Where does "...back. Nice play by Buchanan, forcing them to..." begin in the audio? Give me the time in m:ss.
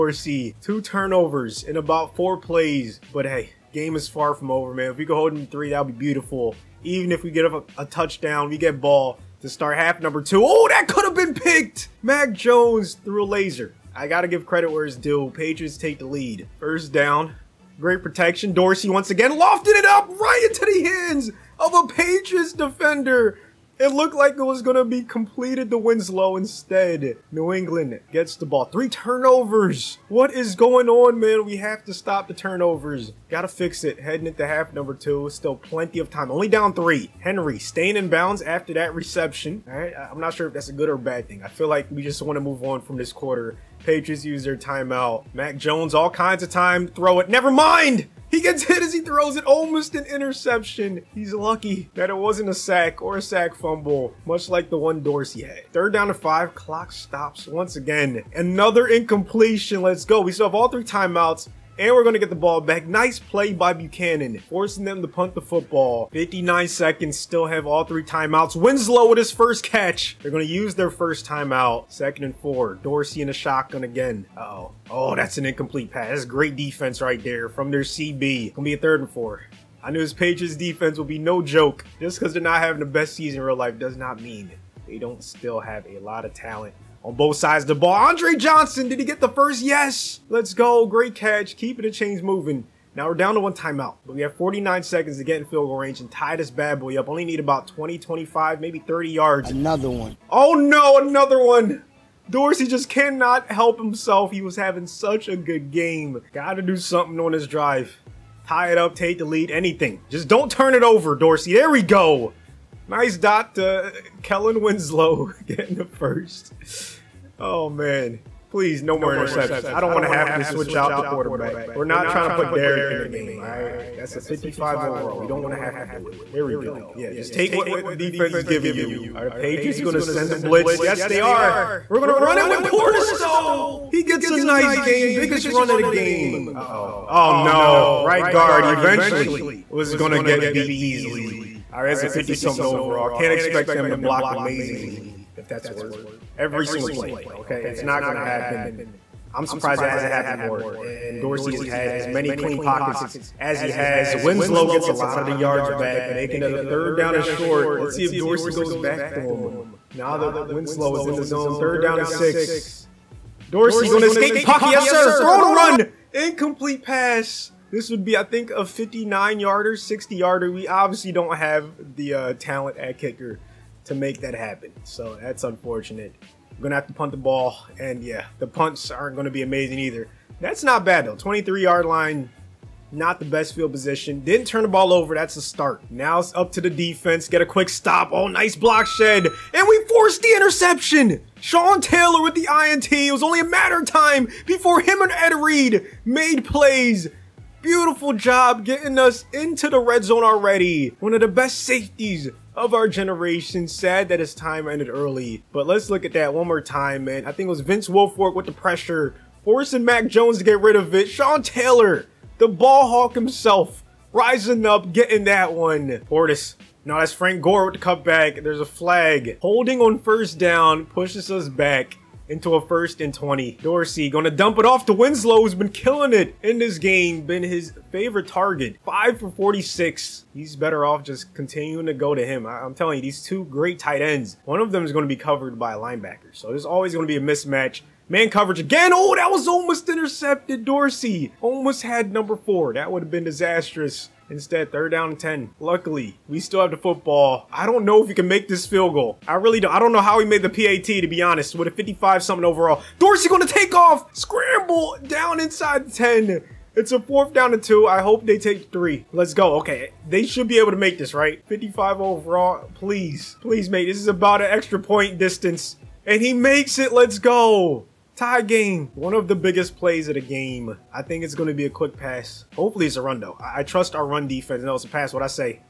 1:02.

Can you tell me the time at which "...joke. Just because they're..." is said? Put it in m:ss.
1:21.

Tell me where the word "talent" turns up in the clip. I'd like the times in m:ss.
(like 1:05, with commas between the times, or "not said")
1:26, 2:52.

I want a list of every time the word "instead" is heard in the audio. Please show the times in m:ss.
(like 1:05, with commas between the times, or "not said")
0:26, 4:04.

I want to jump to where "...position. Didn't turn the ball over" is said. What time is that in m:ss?
3:03.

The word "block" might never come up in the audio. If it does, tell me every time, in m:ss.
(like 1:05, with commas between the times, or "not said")
2:23, 3:08.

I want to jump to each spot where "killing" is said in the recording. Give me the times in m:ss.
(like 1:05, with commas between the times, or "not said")
3:45.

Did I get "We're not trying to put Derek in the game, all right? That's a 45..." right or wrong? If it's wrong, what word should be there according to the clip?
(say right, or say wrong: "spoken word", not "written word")
wrong: "55", not "45".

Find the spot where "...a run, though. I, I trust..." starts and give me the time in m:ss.
4:32.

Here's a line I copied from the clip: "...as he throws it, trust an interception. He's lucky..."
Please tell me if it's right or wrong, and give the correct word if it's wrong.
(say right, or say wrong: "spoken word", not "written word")
wrong: "almost", not "trust".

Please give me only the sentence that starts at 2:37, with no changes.
Let's see if Dorsey goes back to him.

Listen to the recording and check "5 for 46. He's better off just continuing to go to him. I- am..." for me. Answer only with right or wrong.
right.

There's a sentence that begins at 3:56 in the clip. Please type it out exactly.
So there's always gonna be a mismatch.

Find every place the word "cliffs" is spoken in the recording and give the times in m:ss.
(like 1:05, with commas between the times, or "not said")
not said.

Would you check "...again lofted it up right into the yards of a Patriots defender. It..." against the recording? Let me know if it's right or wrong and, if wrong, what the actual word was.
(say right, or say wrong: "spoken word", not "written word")
wrong: "hands", not "yards".